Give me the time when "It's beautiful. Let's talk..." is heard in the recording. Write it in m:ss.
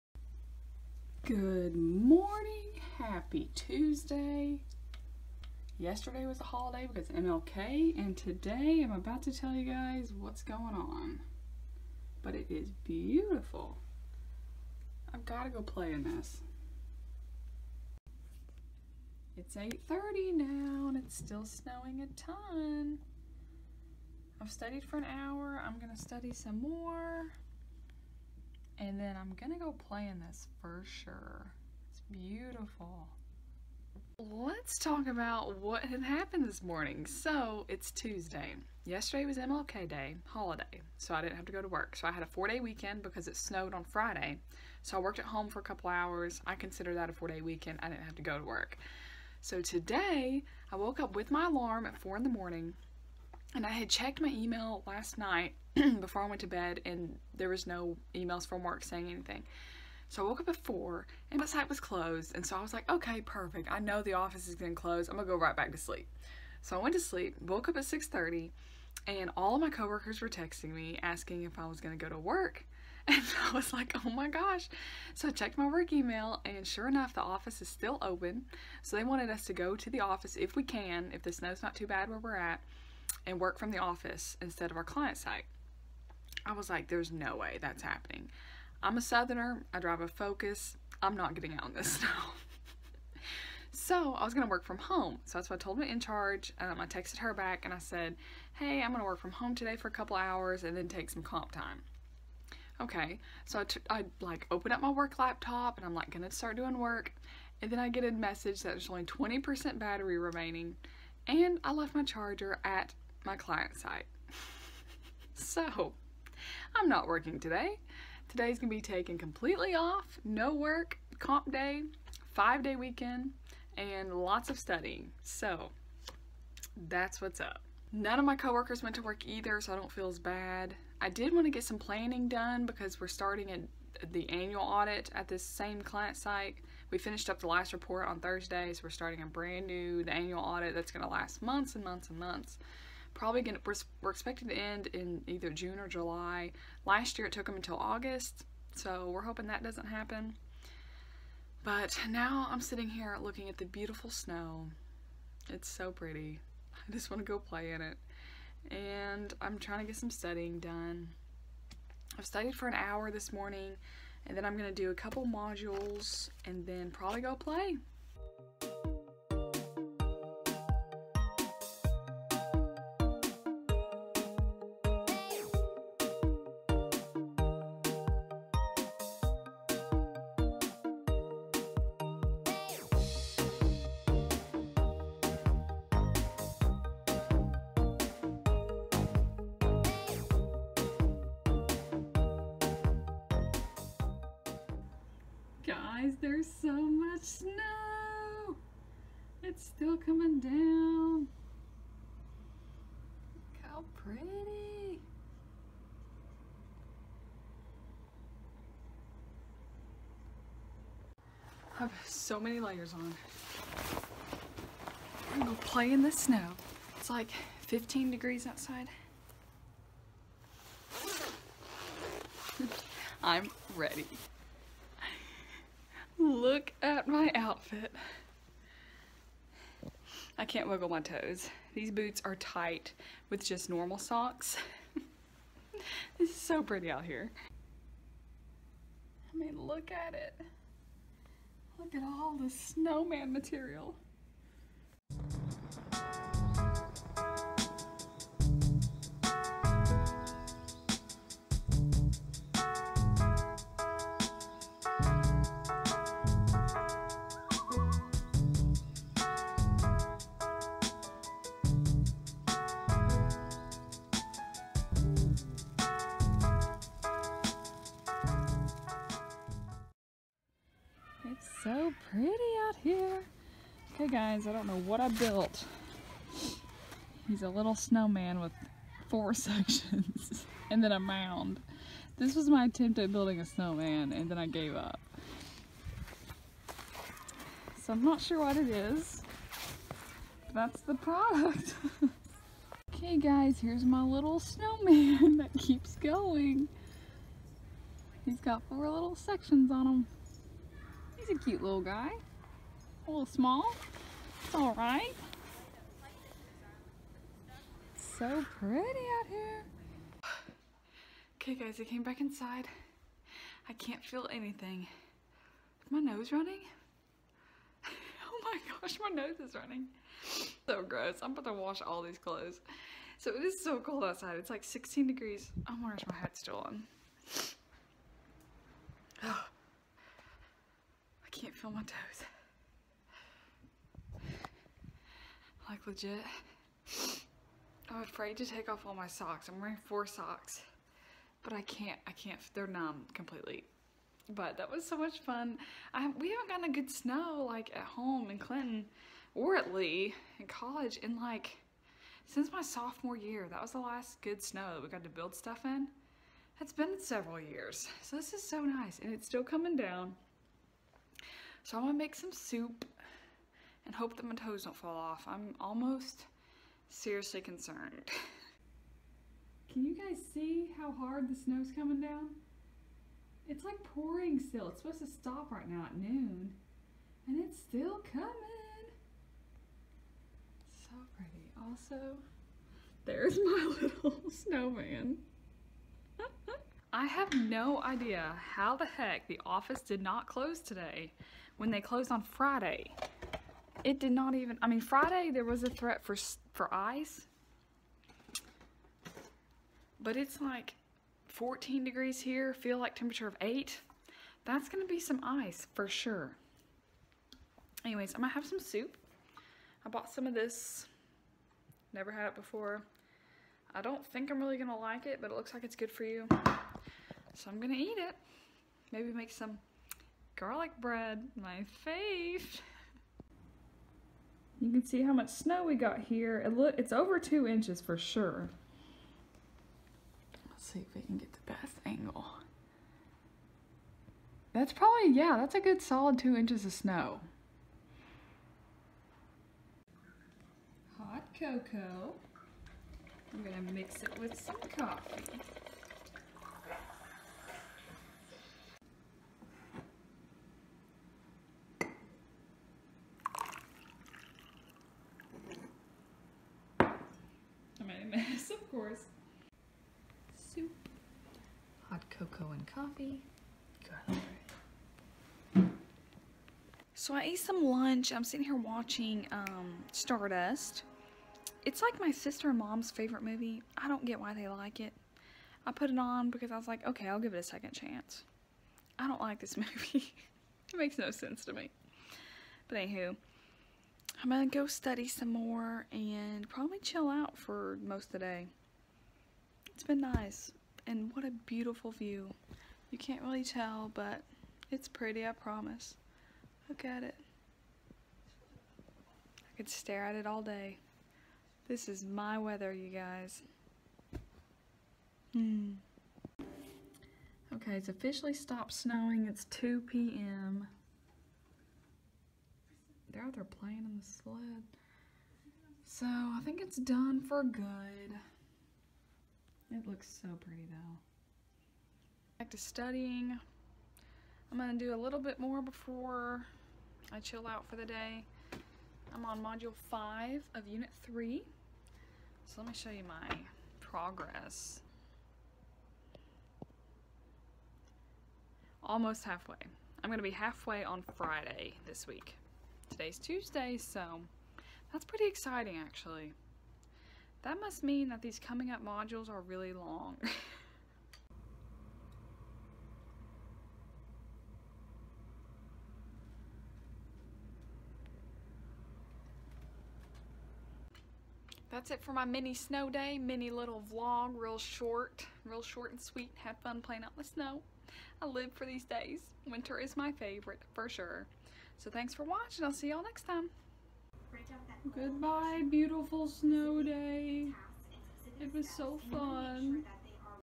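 0:31.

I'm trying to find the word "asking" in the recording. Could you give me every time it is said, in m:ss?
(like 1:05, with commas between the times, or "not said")
1:11.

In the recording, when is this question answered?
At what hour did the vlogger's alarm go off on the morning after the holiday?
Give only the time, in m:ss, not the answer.
0:51.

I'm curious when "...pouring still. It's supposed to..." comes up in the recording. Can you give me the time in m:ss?
6:13.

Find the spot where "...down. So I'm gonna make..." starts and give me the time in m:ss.
5:59.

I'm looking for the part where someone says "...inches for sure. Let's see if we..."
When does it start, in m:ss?
7:07.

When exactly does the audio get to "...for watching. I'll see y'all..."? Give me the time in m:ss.
9:32.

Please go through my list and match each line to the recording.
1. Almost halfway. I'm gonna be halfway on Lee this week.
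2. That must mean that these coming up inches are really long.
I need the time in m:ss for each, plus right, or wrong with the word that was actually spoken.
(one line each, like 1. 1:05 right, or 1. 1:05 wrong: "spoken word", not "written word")
1. 8:58 wrong: "Friday", not "Lee"
2. 9:07 wrong: "modules", not "inches".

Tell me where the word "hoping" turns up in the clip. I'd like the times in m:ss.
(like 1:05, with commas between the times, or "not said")
2:29.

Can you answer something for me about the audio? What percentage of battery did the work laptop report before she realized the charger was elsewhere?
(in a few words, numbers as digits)
20%.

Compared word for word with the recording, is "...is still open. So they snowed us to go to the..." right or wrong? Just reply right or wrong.
wrong.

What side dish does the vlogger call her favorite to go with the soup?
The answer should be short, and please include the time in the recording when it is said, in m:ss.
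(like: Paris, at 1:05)
garlic bread, at 7:00.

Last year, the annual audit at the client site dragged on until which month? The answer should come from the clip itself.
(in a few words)
August.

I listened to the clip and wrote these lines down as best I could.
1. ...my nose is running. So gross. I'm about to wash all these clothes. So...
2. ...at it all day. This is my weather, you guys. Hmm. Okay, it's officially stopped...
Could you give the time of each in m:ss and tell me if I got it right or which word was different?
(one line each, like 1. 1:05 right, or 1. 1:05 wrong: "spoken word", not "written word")
1. 5:19 right
2. 8:20 right.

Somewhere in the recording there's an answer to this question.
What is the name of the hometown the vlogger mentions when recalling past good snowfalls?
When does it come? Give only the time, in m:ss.
5:48.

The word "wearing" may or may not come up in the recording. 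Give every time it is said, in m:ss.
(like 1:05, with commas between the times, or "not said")
5:25, 5:39.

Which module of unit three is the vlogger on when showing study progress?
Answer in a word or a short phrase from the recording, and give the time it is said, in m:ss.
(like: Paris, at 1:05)
module 5, at 8:49.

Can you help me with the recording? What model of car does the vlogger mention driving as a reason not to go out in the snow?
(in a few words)
Focus.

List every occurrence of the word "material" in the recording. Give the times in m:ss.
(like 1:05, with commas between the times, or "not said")
4:03.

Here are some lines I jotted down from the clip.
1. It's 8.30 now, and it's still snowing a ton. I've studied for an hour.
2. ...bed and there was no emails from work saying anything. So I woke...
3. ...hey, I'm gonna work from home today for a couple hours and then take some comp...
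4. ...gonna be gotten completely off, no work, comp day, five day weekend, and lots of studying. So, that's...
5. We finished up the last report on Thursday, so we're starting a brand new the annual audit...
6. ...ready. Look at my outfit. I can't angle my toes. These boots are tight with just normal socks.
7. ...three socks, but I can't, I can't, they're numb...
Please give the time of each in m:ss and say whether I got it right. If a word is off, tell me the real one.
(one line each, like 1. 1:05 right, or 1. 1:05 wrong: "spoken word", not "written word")
1. 0:19 right
2. 0:56 right
3. 1:38 right
4. 1:58 wrong: "taken", not "gotten"
5. 2:16 right
6. 3:43 wrong: "wiggle", not "angle"
7. 5:39 wrong: "four", not "three".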